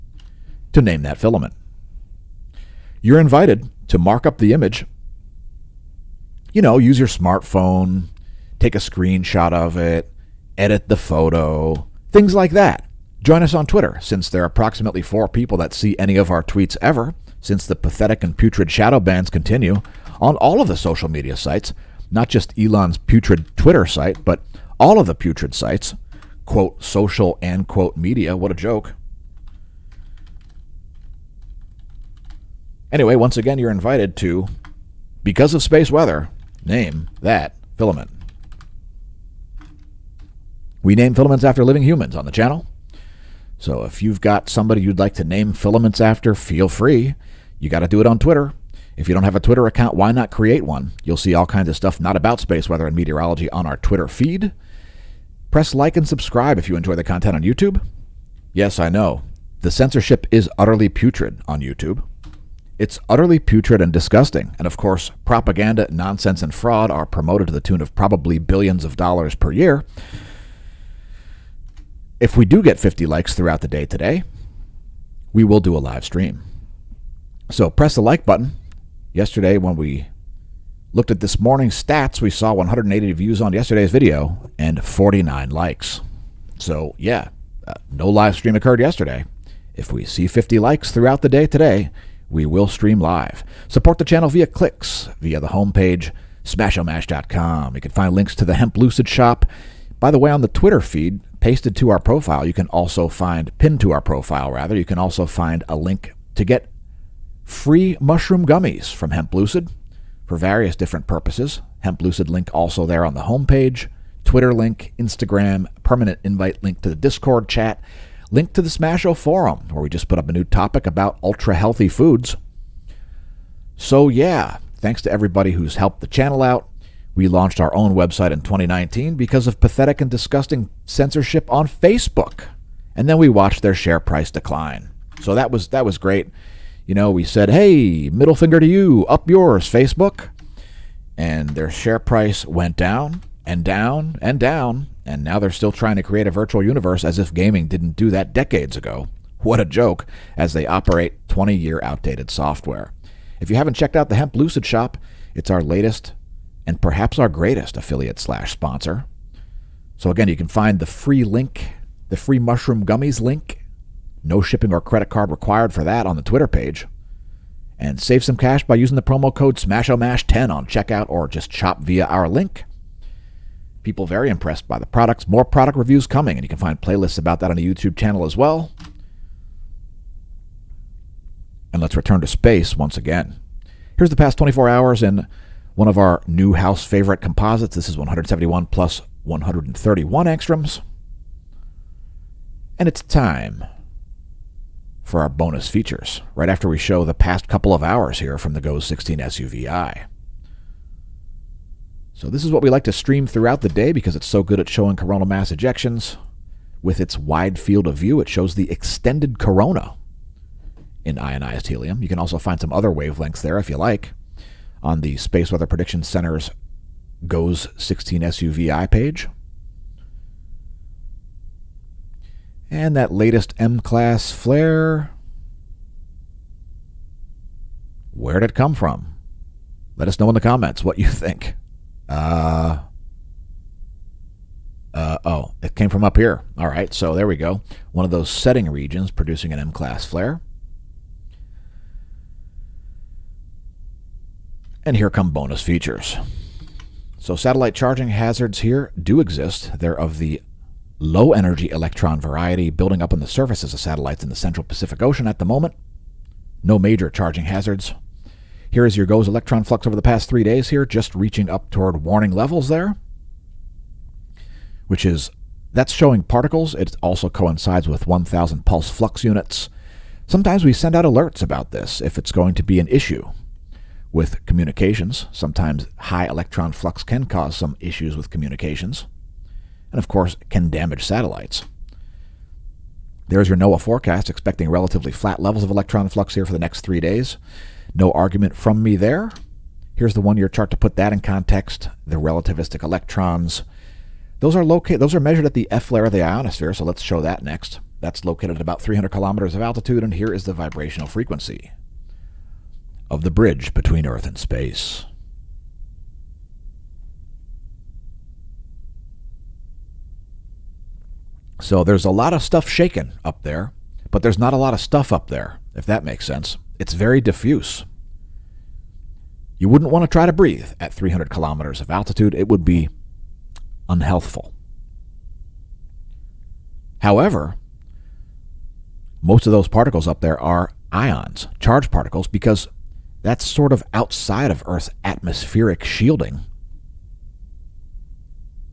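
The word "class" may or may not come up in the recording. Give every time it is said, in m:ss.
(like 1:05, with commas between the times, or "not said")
3:43, 3:59.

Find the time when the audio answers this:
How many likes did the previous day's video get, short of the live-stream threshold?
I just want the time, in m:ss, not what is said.
1:24.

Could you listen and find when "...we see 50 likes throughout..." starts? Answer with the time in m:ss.
1:29.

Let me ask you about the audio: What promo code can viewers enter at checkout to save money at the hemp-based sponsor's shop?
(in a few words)
SMASHOMASH10.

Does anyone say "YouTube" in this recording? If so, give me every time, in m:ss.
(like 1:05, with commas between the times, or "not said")
0:57, 1:01, 2:57.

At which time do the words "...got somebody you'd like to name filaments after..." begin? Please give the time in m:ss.
0:44.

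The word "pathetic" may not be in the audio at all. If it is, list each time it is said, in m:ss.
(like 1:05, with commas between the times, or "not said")
0:17, 2:09.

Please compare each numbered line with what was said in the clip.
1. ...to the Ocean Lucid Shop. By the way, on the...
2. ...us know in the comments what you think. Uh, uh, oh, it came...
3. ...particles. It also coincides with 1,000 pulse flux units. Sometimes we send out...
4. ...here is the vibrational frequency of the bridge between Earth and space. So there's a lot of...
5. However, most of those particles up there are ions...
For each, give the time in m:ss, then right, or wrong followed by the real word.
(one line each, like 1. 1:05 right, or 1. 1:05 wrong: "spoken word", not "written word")
1. 1:38 wrong: "Hemp", not "Ocean"
2. 3:50 right
3. 4:26 right
4. 5:00 right
5. 5:26 right.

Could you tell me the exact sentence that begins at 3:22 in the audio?
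So this is what we like to stream throughout the day because it's so good at showing coronal mass ejections.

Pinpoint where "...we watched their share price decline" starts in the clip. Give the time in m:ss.
2:13.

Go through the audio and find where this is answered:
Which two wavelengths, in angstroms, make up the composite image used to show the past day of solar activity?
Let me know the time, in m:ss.
3:07.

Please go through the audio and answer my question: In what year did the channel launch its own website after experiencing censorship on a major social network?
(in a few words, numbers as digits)
2019.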